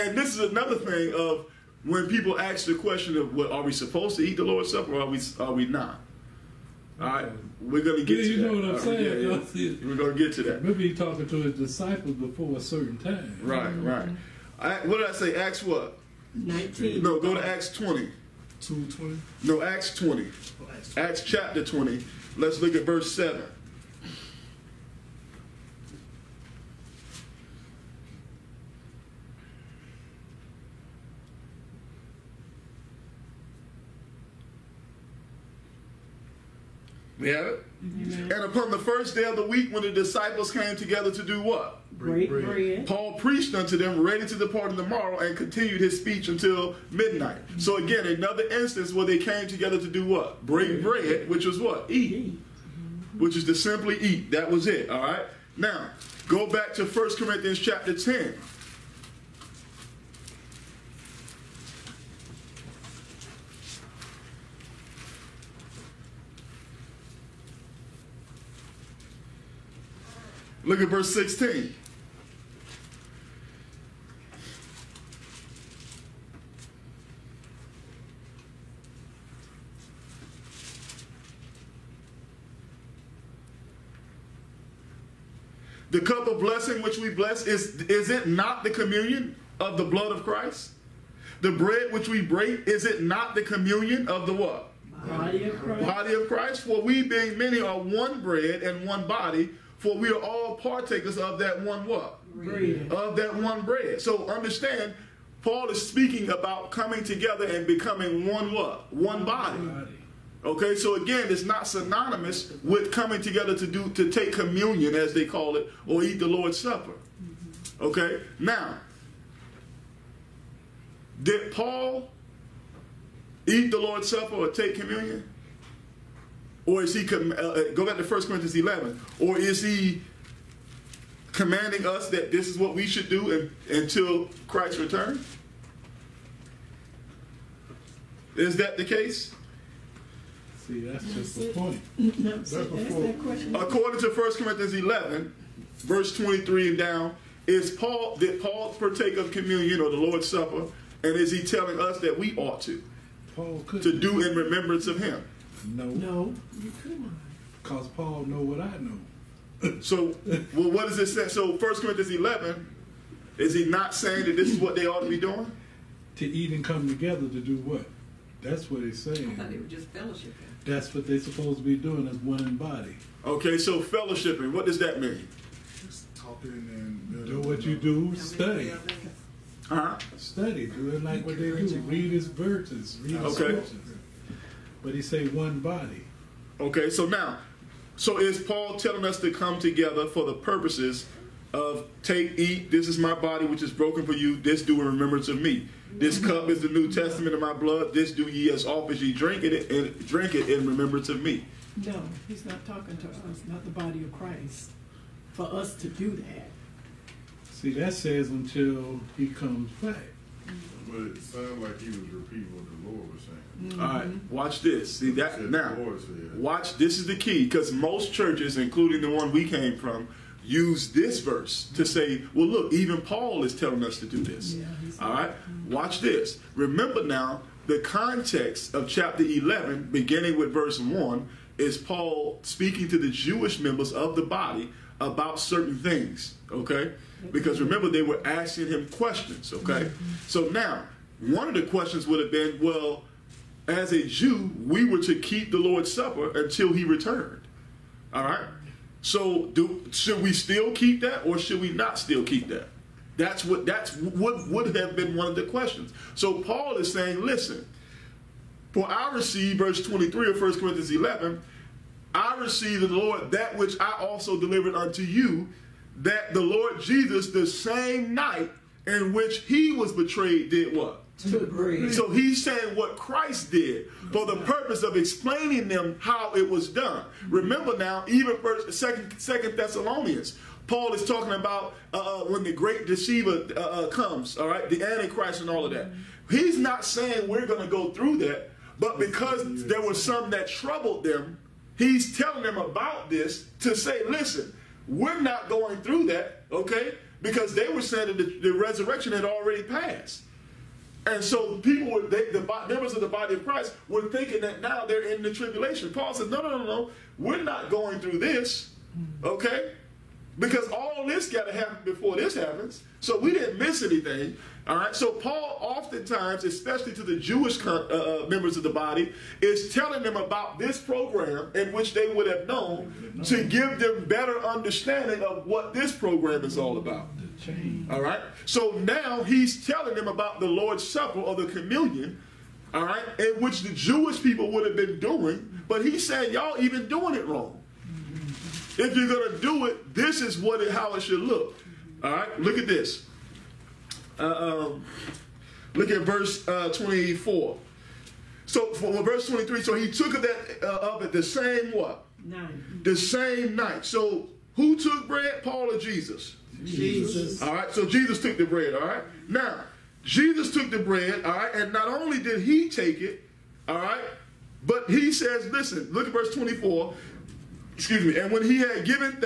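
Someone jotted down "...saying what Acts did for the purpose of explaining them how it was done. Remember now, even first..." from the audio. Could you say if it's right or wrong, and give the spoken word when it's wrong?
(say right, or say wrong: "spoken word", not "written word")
wrong: "Christ", not "Acts".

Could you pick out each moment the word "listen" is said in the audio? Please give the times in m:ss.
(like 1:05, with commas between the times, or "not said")
4:17, 4:54, 6:05.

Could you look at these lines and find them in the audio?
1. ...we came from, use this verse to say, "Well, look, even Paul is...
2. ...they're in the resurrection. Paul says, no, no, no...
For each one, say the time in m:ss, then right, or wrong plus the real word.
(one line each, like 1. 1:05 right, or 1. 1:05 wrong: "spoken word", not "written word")
1. 3:39 right
2. 5:04 wrong: "tribulation", not "resurrection".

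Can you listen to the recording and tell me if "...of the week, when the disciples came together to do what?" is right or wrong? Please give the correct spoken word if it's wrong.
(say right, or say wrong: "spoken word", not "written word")
right.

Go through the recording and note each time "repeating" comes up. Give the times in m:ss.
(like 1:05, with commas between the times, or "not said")
3:31.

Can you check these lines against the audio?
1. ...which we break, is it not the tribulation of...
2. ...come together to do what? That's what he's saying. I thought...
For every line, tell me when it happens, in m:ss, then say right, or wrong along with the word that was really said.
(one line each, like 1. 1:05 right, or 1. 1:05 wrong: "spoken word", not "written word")
1. 1:31 wrong: "communion", not "tribulation"
2. 2:46 right.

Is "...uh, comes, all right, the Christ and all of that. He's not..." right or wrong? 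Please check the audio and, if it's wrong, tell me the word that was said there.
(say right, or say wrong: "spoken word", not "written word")
wrong: "Antichrist", not "Christ".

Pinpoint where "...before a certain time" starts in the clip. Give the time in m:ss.
0:12.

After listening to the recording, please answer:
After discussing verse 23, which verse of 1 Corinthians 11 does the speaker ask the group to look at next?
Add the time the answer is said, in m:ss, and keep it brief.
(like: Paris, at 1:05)
24, at 5:46.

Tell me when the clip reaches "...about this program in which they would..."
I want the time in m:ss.
5:20.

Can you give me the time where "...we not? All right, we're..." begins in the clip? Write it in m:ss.
0:05.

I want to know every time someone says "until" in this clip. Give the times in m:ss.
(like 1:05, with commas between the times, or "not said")
0:46, 2:13, 3:28, 4:06.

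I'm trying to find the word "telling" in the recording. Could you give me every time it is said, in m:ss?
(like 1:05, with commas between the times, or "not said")
2:31, 3:08, 3:43, 4:52, 5:19, 5:29.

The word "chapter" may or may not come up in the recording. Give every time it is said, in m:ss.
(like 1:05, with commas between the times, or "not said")
0:21, 0:57, 3:48.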